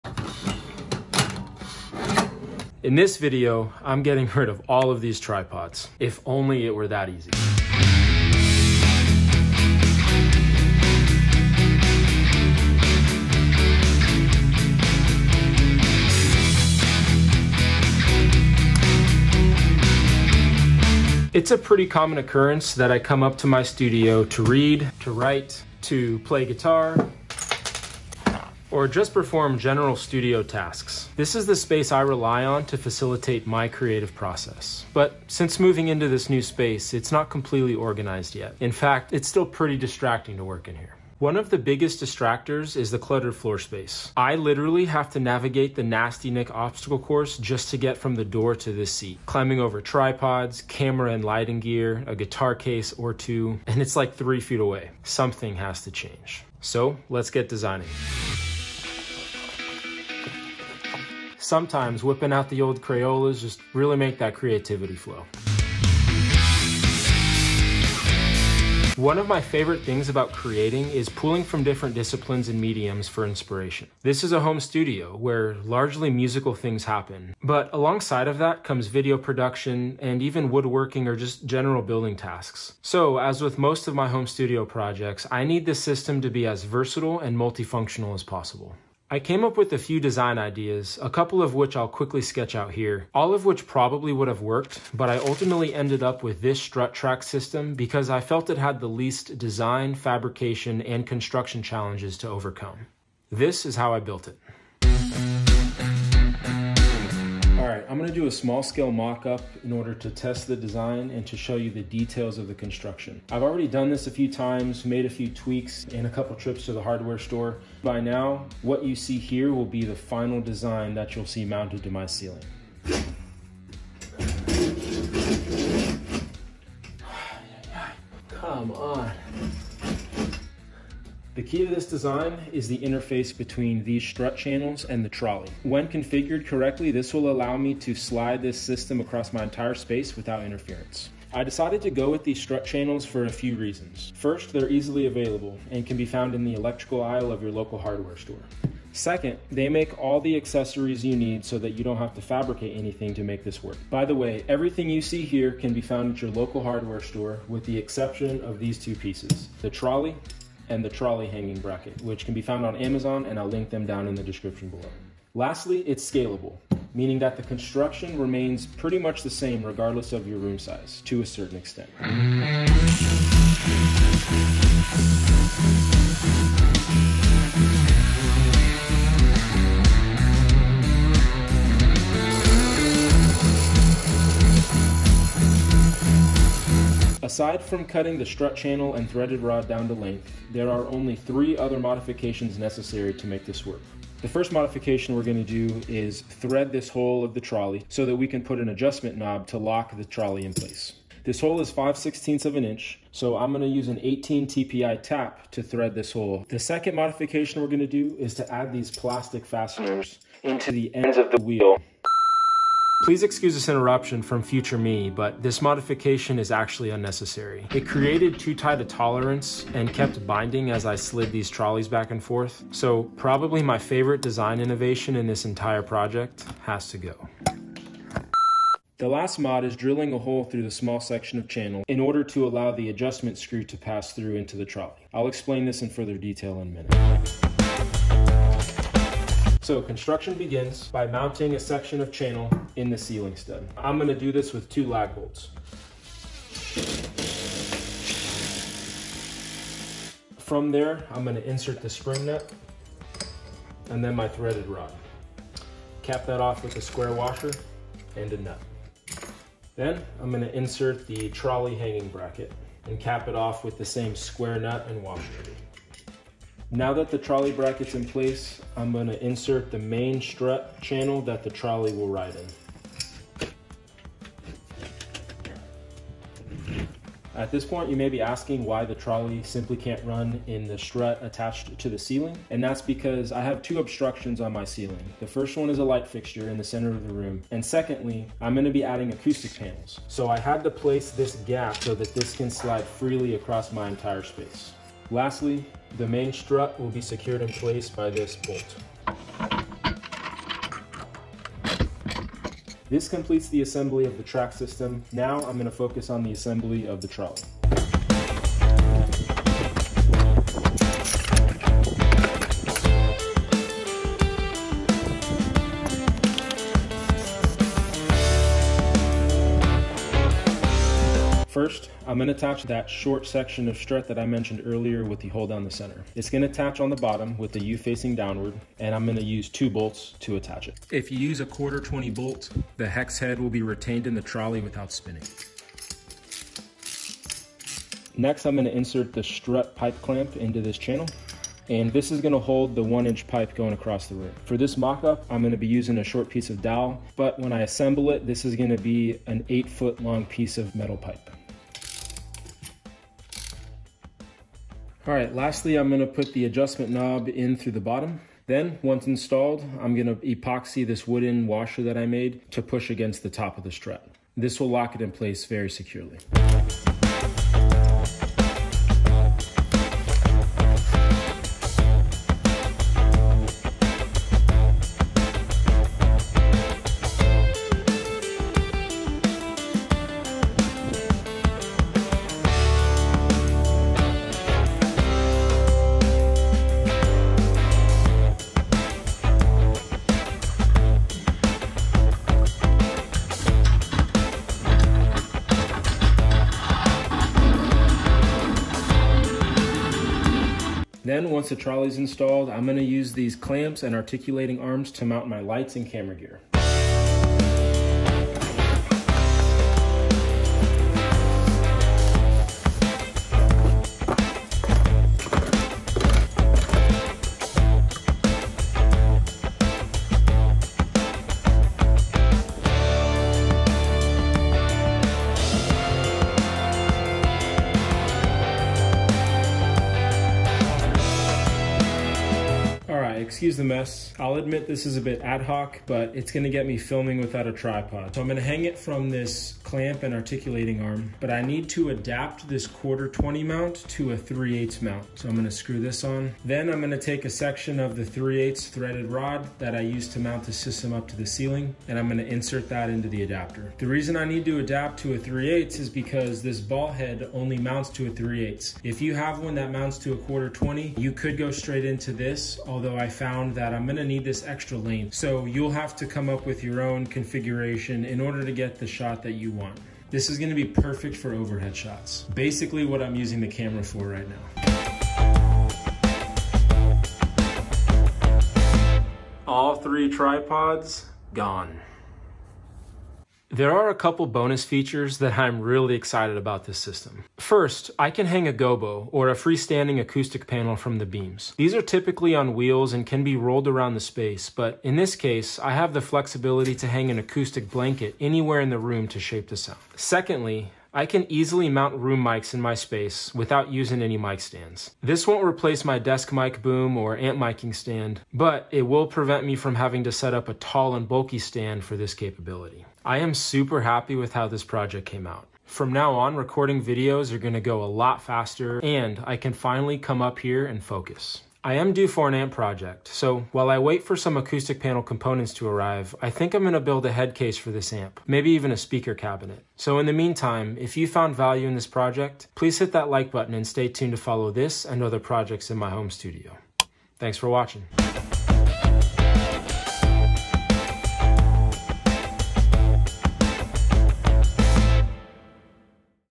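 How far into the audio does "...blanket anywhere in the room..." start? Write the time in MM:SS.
08:17.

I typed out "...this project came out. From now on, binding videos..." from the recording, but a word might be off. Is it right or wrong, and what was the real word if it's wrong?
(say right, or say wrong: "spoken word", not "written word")
wrong: "recording", not "binding".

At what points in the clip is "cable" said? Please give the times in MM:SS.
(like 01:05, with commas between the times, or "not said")
not said.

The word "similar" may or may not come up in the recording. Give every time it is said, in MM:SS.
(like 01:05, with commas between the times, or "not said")
not said.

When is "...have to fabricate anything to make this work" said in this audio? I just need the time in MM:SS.
02:31.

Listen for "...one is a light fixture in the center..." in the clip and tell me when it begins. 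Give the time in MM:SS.
04:45.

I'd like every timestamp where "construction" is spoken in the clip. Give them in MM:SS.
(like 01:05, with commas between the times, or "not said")
01:41, 01:52, 02:47, 03:59.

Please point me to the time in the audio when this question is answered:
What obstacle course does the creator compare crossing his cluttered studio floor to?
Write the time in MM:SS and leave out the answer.
00:45.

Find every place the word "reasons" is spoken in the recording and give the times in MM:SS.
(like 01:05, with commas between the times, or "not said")
02:23, 07:33.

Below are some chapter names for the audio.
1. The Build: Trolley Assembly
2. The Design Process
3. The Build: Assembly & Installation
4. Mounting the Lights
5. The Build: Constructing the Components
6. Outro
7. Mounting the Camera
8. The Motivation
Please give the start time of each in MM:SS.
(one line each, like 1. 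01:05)
1. 05:07
2. 00:58
3. 03:58
4. 06:41
5. 01:45
6. 08:32
7. 07:12
8. 00:21.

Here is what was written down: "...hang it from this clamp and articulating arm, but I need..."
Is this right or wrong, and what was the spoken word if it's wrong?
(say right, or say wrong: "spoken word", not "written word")
right.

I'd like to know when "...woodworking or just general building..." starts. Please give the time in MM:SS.
01:20.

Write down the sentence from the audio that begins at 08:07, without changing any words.
First, I can hang a gobo, or a freestanding acoustic panel from the beams.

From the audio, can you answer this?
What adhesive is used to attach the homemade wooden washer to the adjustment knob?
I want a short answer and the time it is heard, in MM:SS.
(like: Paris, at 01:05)
epoxy, at 06:00.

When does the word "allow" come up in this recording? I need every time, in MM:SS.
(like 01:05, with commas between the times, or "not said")
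02:17, 03:52.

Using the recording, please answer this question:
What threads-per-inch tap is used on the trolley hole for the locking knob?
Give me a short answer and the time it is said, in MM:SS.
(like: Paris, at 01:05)
18 TPI, at 03:24.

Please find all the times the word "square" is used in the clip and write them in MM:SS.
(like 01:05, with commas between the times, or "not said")
04:16, 04:24.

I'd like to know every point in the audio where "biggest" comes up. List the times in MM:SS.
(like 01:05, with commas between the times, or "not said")
00:41.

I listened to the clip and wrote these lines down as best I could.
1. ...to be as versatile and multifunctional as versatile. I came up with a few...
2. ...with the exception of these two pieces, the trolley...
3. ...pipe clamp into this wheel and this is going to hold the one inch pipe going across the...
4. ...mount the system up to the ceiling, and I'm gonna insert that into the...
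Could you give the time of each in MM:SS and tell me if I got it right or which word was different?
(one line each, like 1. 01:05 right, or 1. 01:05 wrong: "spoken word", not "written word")
1. 01:26 wrong: "possible", not "versatile"
2. 02:37 right
3. 05:39 wrong: "channel", not "wheel"
4. 07:30 right.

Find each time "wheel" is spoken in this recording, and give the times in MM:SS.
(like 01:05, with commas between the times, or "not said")
03:31, 08:12.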